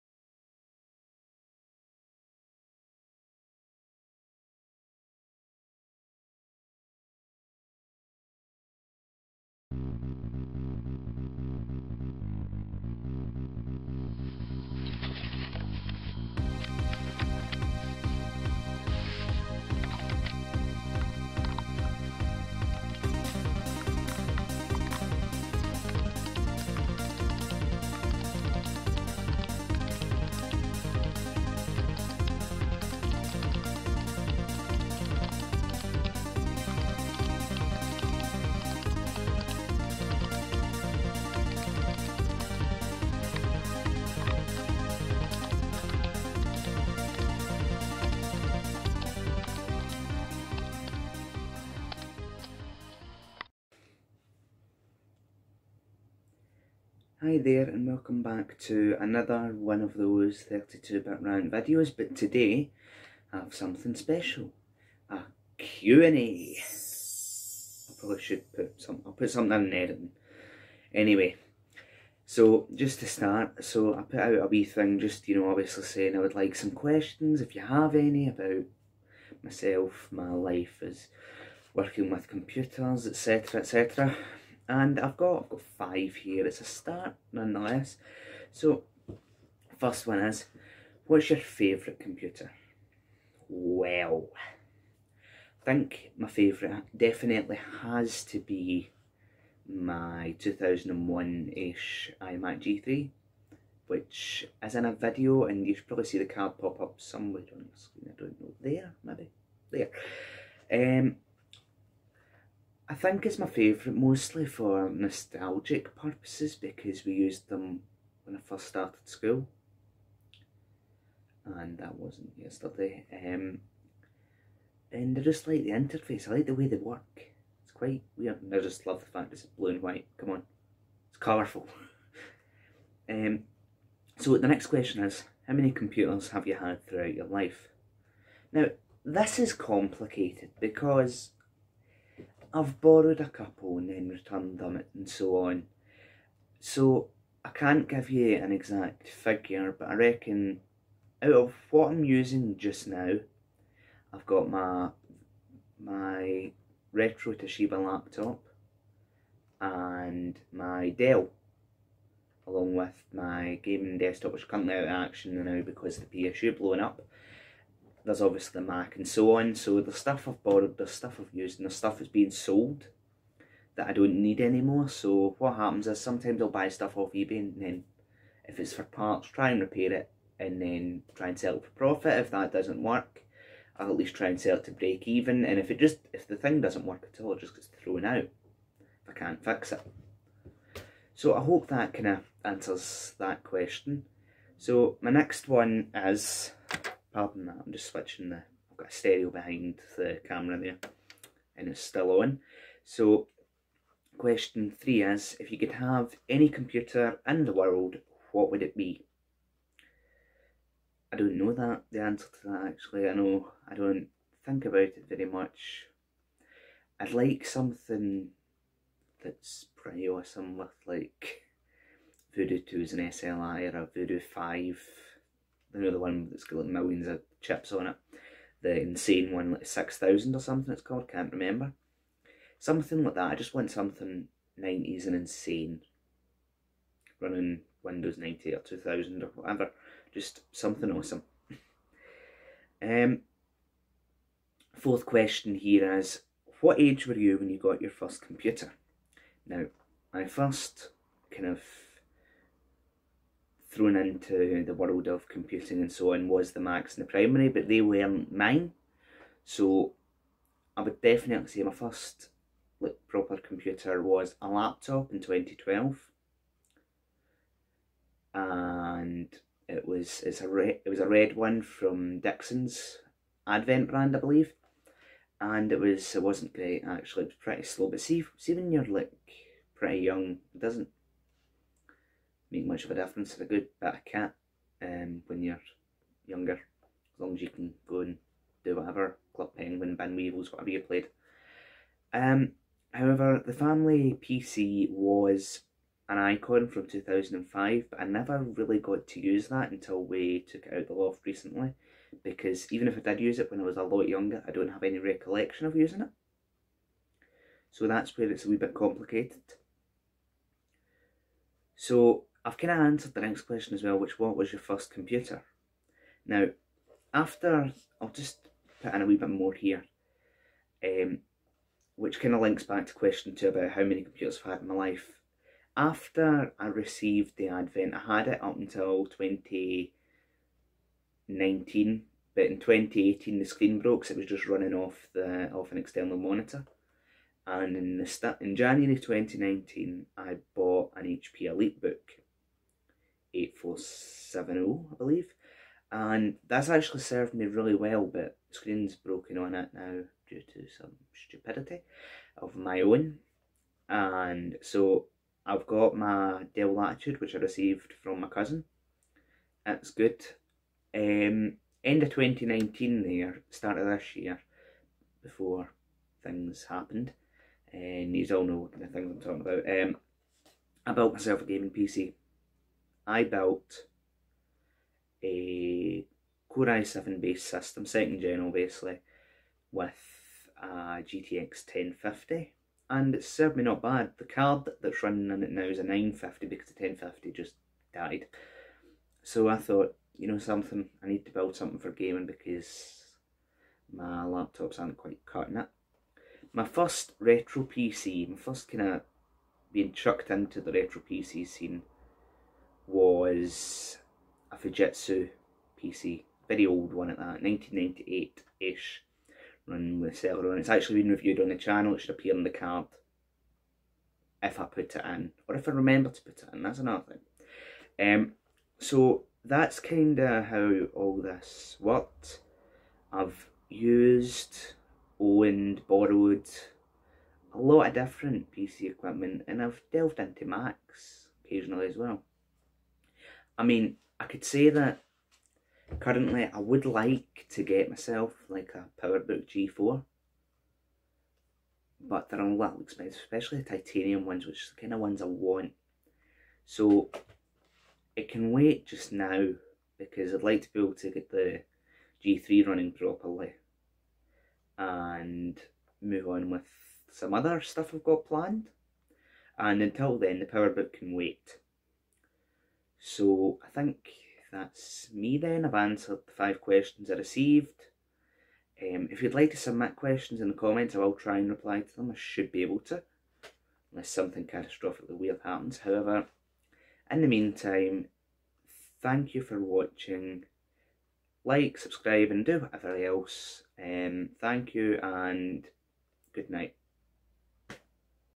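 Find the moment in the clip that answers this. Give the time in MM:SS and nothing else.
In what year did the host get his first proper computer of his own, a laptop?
04:25.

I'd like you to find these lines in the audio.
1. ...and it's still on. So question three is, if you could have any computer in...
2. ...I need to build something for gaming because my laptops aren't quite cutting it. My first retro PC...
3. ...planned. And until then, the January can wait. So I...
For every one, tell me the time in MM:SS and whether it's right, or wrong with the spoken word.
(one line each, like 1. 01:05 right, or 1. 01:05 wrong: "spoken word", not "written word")
1. 03:21 right
2. 06:31 right
3. 07:38 wrong: "PowerBook", not "January".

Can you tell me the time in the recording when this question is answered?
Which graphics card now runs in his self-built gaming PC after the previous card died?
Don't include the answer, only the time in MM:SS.
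06:25.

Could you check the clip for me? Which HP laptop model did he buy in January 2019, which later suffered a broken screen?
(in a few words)
EliteBook 8470.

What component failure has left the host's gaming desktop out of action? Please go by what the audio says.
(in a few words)
PSU.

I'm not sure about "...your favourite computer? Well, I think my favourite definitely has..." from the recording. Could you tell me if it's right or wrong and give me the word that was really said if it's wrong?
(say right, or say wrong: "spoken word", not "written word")
right.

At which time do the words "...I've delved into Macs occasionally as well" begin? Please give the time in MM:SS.
07:09.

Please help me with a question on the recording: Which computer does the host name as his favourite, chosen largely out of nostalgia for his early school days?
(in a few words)
iMac G3.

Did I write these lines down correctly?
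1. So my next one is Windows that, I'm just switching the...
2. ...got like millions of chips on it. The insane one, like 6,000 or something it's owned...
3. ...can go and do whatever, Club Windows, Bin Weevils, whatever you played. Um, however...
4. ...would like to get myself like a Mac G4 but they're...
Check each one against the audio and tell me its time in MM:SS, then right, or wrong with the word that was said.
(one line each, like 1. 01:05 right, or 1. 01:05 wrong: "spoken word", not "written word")
1. 03:14 wrong: "Pardon", not "Windows"
2. 03:46 wrong: "called", not "owned"
3. 04:47 wrong: "Penguin", not "Windows"
4. 07:16 wrong: "PowerBook", not "Mac".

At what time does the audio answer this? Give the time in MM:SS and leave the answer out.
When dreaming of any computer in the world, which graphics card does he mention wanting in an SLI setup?
03:42.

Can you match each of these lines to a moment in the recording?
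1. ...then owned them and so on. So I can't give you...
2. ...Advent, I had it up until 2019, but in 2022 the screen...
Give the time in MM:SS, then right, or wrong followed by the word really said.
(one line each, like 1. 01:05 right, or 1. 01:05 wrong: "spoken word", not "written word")
1. 02:23 wrong: "returned", not "owned"
2. 05:27 wrong: "2018", not "2022".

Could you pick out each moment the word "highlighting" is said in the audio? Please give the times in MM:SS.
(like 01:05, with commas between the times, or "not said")
not said.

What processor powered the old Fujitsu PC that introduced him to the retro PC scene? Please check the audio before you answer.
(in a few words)
Celeron.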